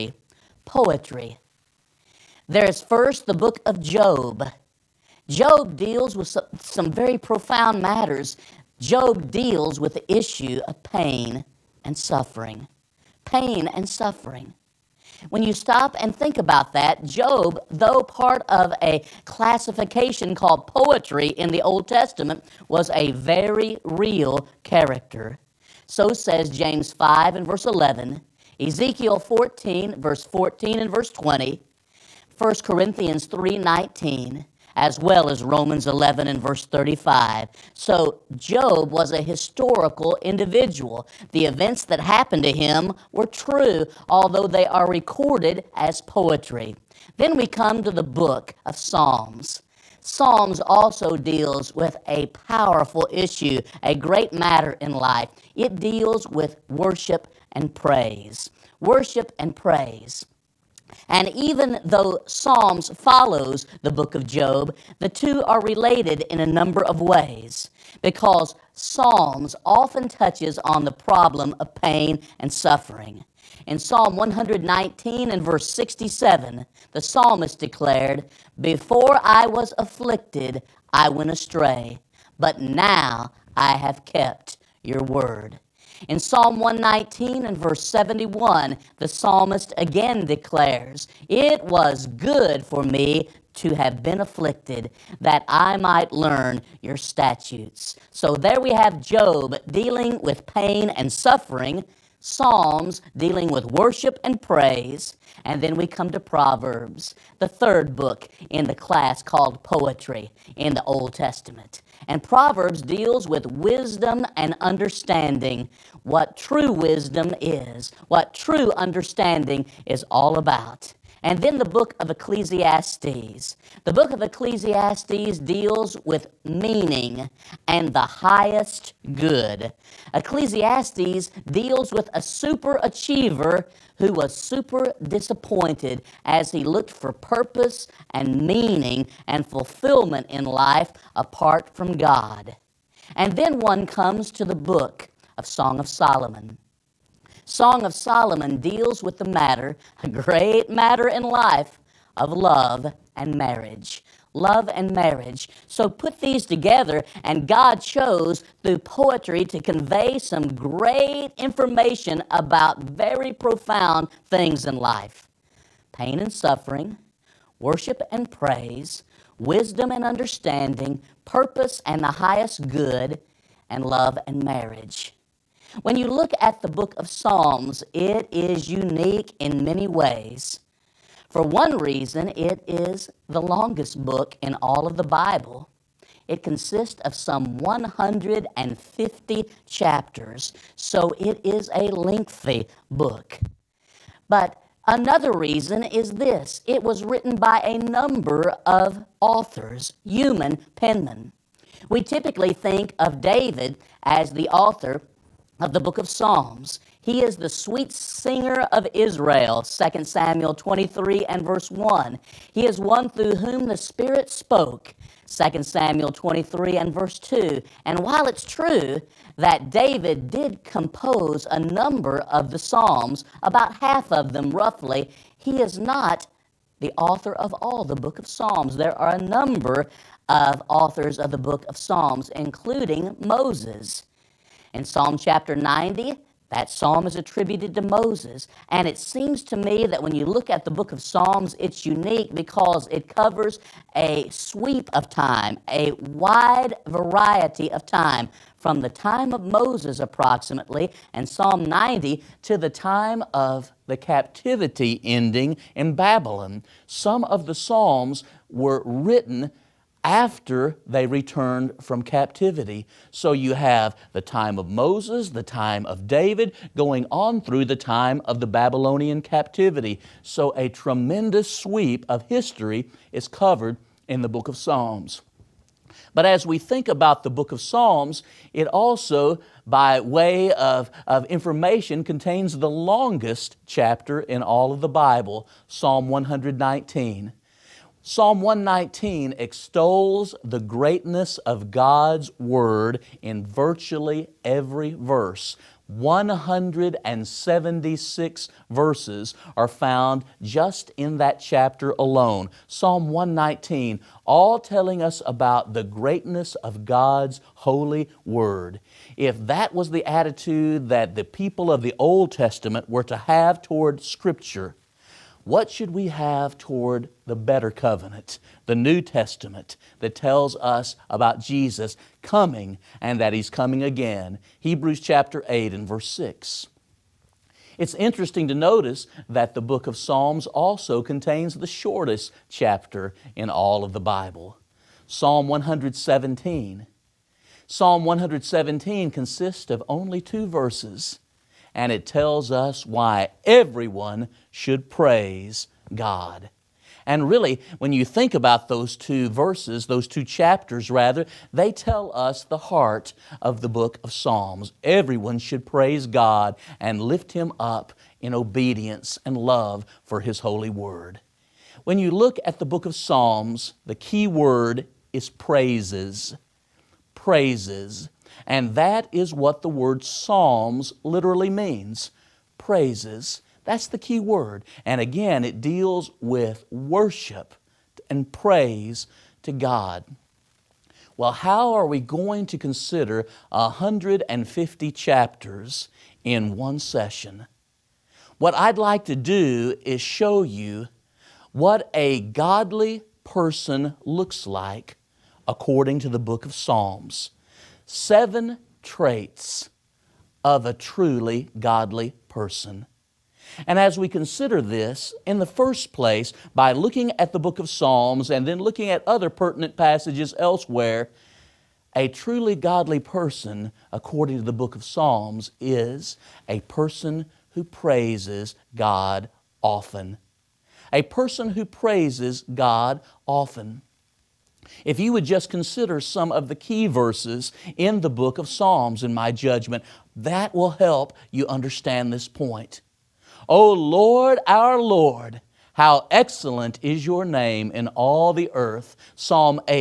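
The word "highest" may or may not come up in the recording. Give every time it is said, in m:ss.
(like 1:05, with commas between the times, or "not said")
2:07, 2:52.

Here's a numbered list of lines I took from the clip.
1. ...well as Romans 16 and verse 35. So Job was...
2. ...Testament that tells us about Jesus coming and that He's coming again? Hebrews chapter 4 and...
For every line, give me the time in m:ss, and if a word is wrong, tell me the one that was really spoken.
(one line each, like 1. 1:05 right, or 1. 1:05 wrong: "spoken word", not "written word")
1. 0:34 wrong: "11", not "16"
2. 5:18 wrong: "8", not "4".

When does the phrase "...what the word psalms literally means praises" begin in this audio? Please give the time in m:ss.
6:09.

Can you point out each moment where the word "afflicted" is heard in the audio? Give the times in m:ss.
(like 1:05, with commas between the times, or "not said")
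1:19, 1:34.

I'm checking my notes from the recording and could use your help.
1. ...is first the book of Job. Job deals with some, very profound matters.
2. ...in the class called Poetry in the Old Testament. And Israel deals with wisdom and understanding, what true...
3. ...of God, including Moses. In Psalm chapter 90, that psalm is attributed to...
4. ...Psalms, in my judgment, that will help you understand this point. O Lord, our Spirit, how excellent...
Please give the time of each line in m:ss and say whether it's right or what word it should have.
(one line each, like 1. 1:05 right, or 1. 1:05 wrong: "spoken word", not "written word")
1. 0:02 right
2. 1:48 wrong: "Proverbs", not "Israel"
3. 3:51 wrong: "Psalms", not "God"
4. 7:08 wrong: "Lord", not "Spirit".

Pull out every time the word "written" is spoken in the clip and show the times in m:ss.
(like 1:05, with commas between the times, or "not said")
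3:17, 4:18.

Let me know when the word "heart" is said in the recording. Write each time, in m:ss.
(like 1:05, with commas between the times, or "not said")
5:52.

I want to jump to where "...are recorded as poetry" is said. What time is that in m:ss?
0:44.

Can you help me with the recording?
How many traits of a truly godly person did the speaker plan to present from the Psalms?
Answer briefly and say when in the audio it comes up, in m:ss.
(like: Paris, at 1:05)
7, at 6:37.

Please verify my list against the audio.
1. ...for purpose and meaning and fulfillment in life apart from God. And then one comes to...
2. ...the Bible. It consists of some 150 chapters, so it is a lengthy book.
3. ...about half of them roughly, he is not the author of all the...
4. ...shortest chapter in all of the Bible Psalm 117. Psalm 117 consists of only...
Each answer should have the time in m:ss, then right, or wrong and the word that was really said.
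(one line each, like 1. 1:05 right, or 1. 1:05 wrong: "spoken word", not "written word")
1. 2:16 right
2. 3:04 right
3. 3:43 right
4. 5:31 right.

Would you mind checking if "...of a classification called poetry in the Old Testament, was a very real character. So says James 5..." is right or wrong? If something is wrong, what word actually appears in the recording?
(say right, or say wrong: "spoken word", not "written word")
right.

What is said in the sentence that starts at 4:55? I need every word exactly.
176 verses are found just in that chapter alone.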